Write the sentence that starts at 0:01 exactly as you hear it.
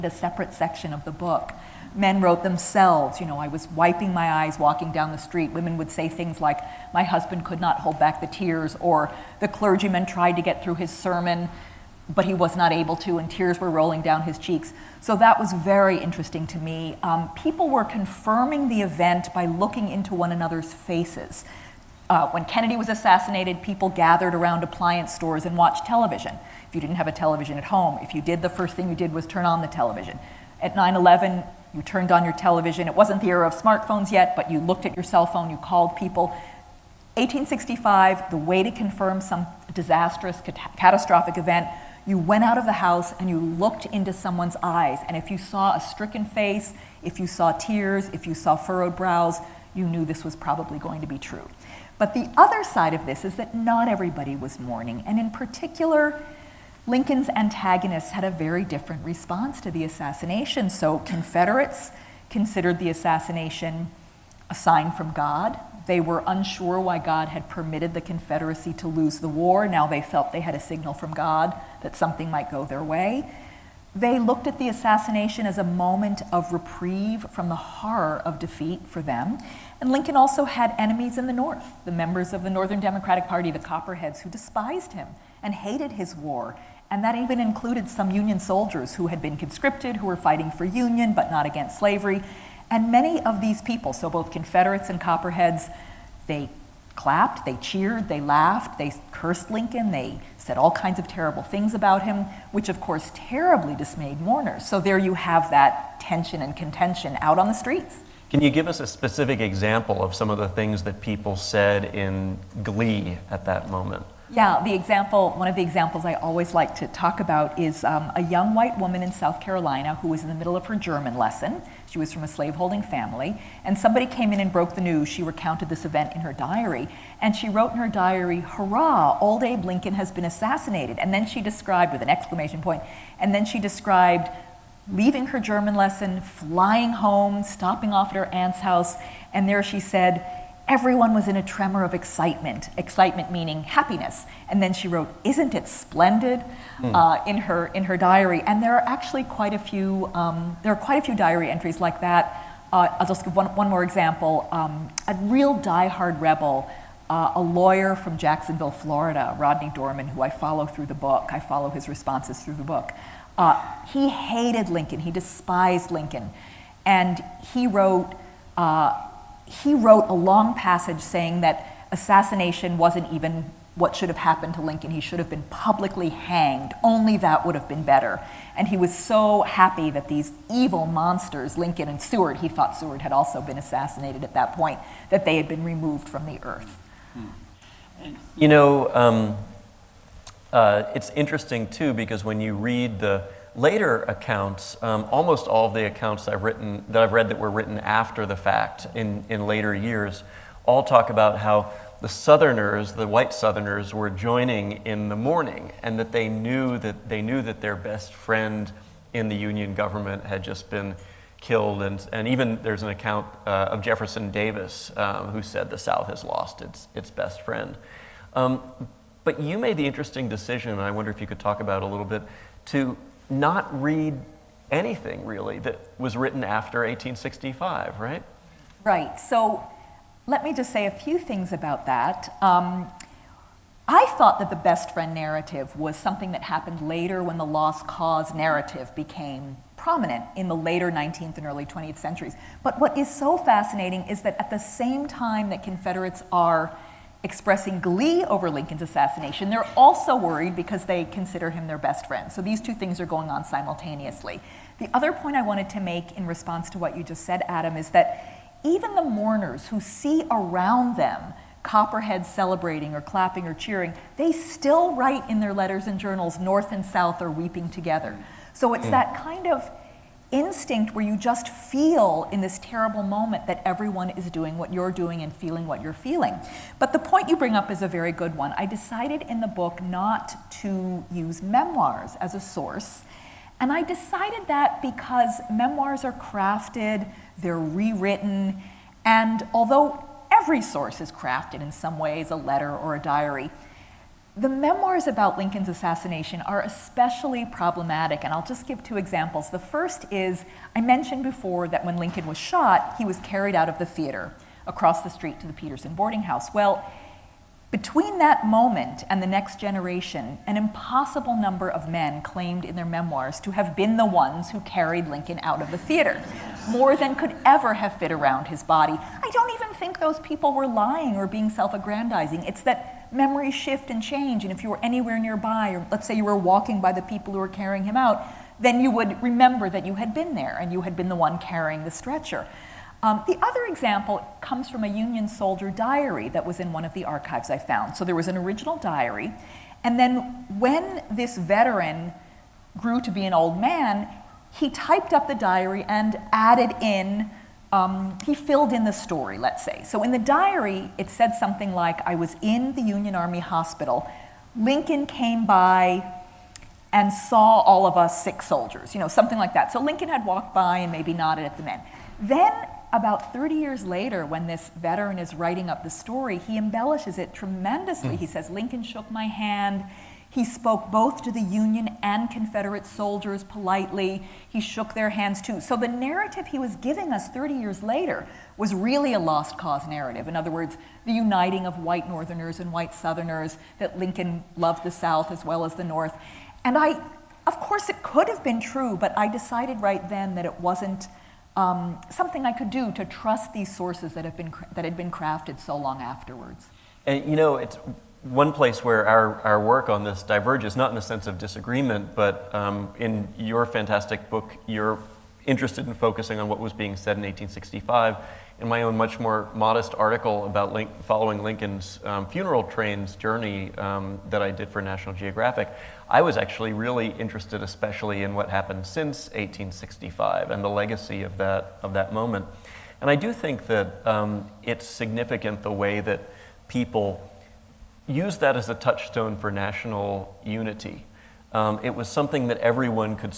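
Men wrote themselves, you know, I was wiping my eyes walking down the street.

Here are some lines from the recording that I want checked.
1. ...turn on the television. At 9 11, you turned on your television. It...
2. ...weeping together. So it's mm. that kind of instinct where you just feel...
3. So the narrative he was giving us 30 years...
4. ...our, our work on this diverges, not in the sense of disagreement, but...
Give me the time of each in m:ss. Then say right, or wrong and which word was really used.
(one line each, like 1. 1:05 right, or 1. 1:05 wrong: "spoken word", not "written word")
1. 0:29 right
2. 4:27 right
3. 6:15 right
4. 6:39 right.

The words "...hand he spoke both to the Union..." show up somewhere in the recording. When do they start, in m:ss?
6:09.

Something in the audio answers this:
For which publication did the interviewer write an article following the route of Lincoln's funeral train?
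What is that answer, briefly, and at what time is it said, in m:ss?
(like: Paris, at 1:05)
National Geographic, at 6:54.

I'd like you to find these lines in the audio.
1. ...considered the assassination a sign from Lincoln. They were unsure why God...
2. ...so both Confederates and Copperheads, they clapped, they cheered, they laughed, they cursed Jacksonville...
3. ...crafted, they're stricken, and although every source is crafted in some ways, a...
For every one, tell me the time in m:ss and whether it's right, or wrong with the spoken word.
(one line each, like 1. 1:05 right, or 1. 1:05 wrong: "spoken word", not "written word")
1. 1:02 wrong: "God", not "Lincoln"
2. 1:33 wrong: "Lincoln", not "Jacksonville"
3. 4:46 wrong: "rewritten", not "stricken".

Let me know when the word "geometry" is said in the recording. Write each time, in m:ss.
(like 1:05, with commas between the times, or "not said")
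not said.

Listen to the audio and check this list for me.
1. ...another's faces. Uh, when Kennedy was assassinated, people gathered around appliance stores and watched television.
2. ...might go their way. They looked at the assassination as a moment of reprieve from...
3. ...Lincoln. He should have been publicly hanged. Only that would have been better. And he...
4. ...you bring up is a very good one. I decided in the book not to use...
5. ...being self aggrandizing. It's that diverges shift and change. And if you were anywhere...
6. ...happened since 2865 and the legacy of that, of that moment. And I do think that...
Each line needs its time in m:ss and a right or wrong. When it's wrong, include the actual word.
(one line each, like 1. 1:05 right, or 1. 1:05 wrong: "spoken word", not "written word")
1. 0:20 right
2. 1:12 right
3. 2:54 right
4. 4:37 right
5. 5:21 wrong: "memories", not "diverges"
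6. 6:58 wrong: "1865", not "2865".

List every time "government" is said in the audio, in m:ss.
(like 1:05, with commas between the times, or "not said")
3:29.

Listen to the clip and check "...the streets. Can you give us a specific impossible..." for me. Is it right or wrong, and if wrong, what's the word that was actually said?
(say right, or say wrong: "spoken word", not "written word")
wrong: "example", not "impossible".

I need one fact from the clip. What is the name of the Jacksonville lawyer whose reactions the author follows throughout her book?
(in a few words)
Rodney Dorman.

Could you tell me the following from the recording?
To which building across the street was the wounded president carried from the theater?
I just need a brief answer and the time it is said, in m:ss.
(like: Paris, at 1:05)
Petersen boarding house, at 5:05.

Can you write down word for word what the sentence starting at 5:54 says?
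Lincoln came by and saw all of us sick soldiers, you know, something like that.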